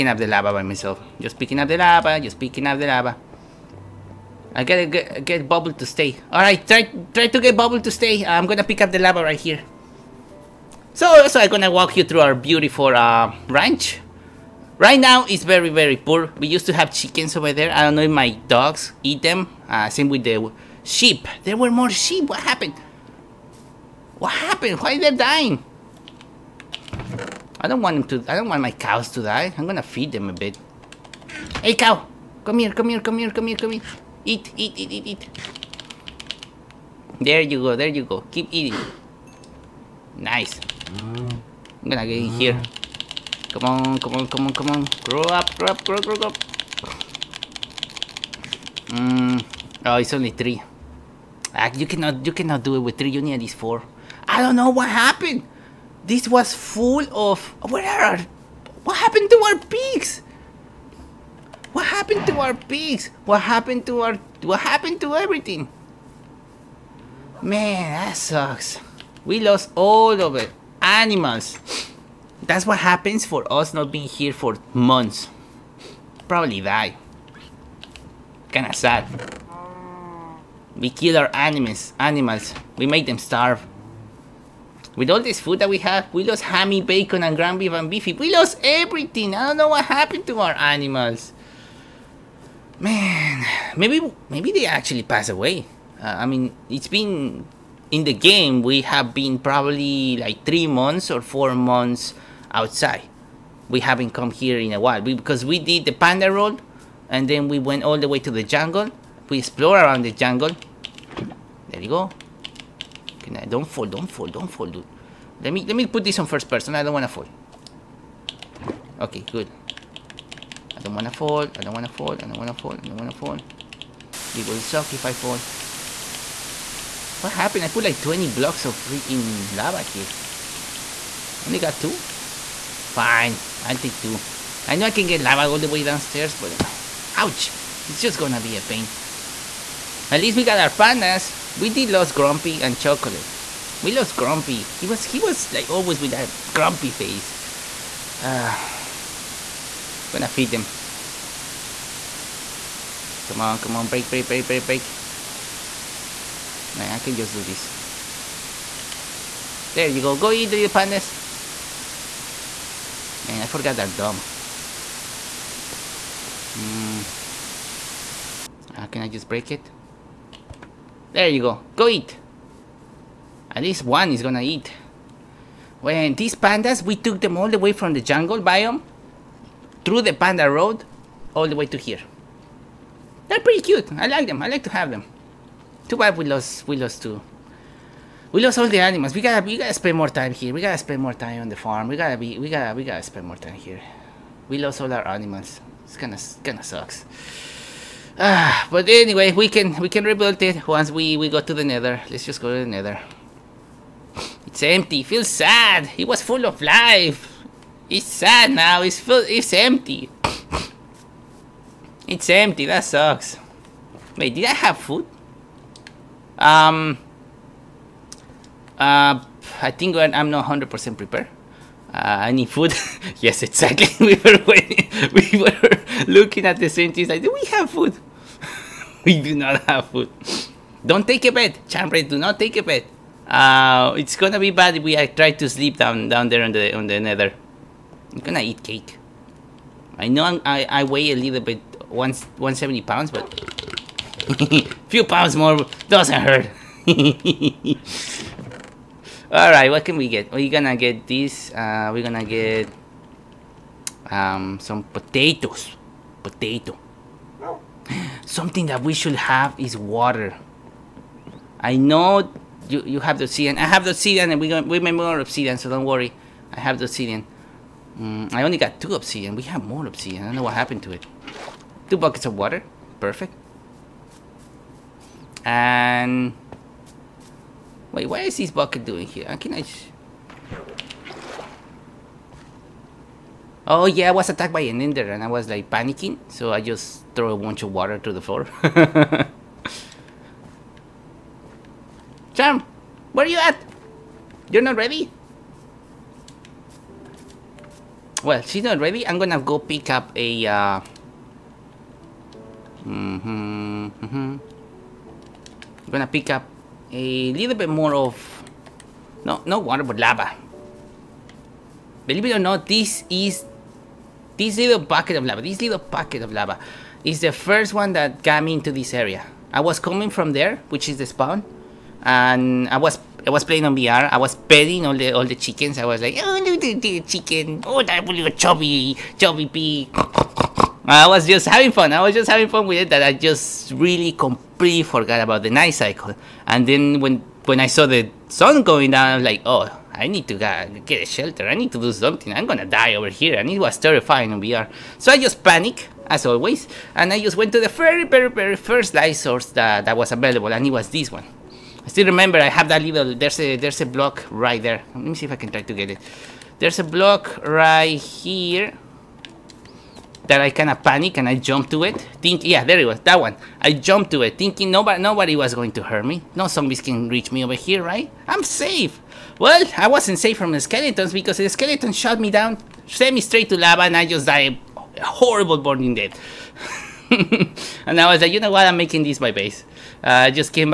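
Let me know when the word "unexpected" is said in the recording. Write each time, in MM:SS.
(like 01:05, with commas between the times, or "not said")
not said.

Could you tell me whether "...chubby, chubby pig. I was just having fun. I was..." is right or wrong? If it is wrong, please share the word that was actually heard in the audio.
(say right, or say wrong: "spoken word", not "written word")
right.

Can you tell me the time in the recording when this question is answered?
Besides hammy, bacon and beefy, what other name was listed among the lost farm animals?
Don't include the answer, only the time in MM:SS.
01:27.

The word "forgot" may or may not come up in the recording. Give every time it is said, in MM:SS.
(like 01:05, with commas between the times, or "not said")
02:43, 05:34.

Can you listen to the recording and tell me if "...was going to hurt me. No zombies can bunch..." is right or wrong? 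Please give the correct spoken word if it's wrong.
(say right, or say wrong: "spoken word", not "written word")
wrong: "reach", not "bunch".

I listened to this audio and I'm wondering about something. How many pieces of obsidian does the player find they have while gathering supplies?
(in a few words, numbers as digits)
2.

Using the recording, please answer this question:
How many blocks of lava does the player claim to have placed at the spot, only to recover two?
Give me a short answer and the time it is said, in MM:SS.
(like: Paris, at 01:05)
20, at 02:08.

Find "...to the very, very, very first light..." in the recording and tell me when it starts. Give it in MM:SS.
05:47.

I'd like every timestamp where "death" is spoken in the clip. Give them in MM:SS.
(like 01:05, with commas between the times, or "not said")
06:15.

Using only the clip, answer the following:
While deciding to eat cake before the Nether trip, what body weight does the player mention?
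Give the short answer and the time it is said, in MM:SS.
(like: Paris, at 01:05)
170 pounds, at 04:01.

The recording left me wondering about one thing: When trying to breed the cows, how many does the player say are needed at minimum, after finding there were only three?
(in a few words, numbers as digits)
4.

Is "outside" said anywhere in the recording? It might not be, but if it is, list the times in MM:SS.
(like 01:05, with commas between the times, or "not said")
01:42.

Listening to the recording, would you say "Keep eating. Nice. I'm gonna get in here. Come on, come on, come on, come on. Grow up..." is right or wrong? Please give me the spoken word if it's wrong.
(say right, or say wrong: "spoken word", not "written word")
right.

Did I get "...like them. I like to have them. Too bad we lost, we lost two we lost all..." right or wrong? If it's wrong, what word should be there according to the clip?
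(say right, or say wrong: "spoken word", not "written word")
right.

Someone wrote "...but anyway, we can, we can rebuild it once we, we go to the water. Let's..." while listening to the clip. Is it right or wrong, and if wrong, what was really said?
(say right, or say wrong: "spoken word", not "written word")
wrong: "nether", not "water".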